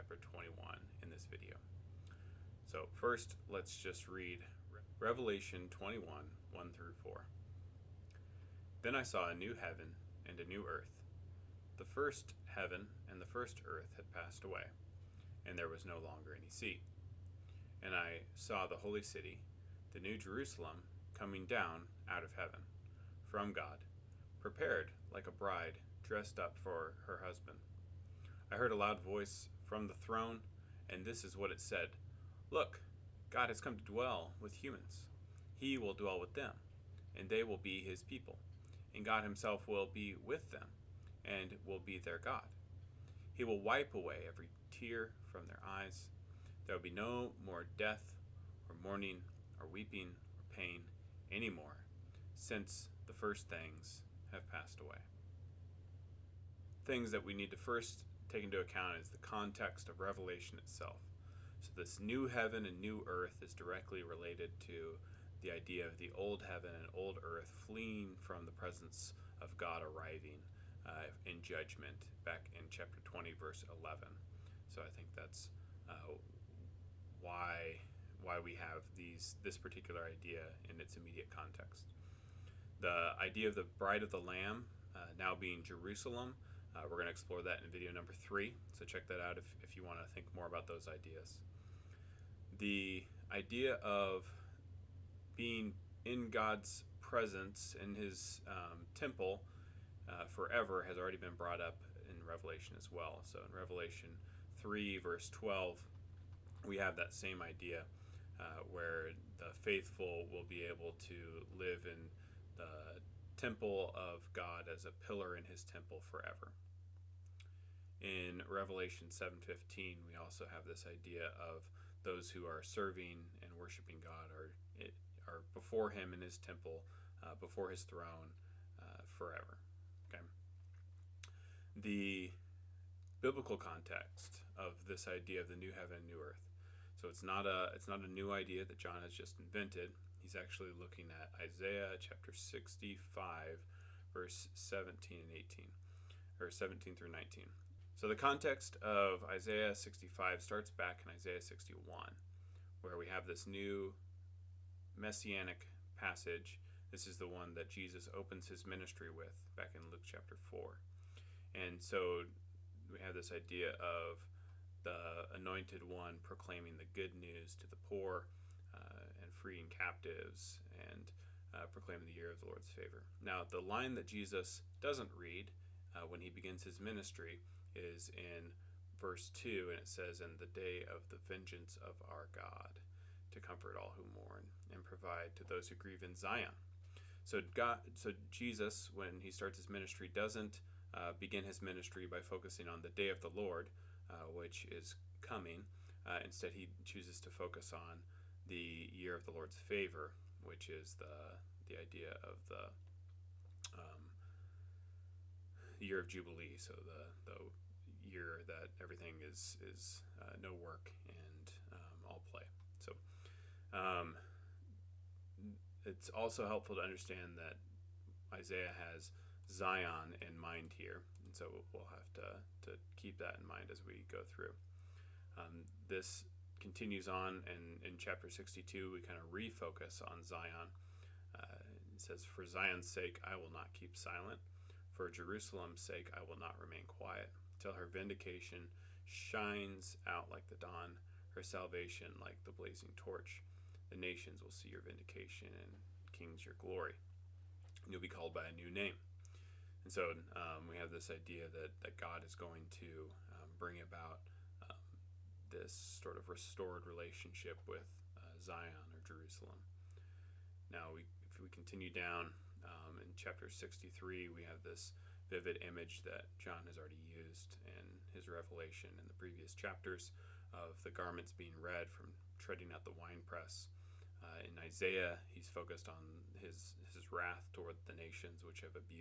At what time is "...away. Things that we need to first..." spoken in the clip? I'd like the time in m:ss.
0:54.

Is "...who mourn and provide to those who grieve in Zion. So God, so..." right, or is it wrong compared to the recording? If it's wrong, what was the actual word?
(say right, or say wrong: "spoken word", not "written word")
right.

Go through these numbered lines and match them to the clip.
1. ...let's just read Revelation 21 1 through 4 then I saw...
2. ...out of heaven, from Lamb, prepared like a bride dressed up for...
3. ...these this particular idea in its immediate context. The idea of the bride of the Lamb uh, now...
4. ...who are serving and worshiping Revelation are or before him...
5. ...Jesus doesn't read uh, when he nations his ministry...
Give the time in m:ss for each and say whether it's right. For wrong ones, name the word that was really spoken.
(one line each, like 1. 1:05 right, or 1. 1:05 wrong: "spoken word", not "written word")
1. 0:03 right
2. 0:22 wrong: "God", not "Lamb"
3. 1:18 right
4. 2:02 wrong: "God", not "Revelation"
5. 2:54 wrong: "begins", not "nations".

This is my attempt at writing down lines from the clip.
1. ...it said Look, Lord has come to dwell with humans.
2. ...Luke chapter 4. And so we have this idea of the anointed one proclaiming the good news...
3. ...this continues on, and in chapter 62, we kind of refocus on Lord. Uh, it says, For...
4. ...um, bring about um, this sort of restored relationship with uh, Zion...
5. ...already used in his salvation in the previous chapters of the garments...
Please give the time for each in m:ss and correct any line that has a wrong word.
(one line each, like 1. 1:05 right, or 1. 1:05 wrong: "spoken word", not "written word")
1. 0:31 wrong: "God", not "Lord"
2. 2:39 right
3. 3:45 wrong: "Zion", not "Lord"
4. 4:13 right
5. 4:26 wrong: "revelation", not "salvation".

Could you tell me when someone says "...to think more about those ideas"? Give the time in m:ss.
1:29.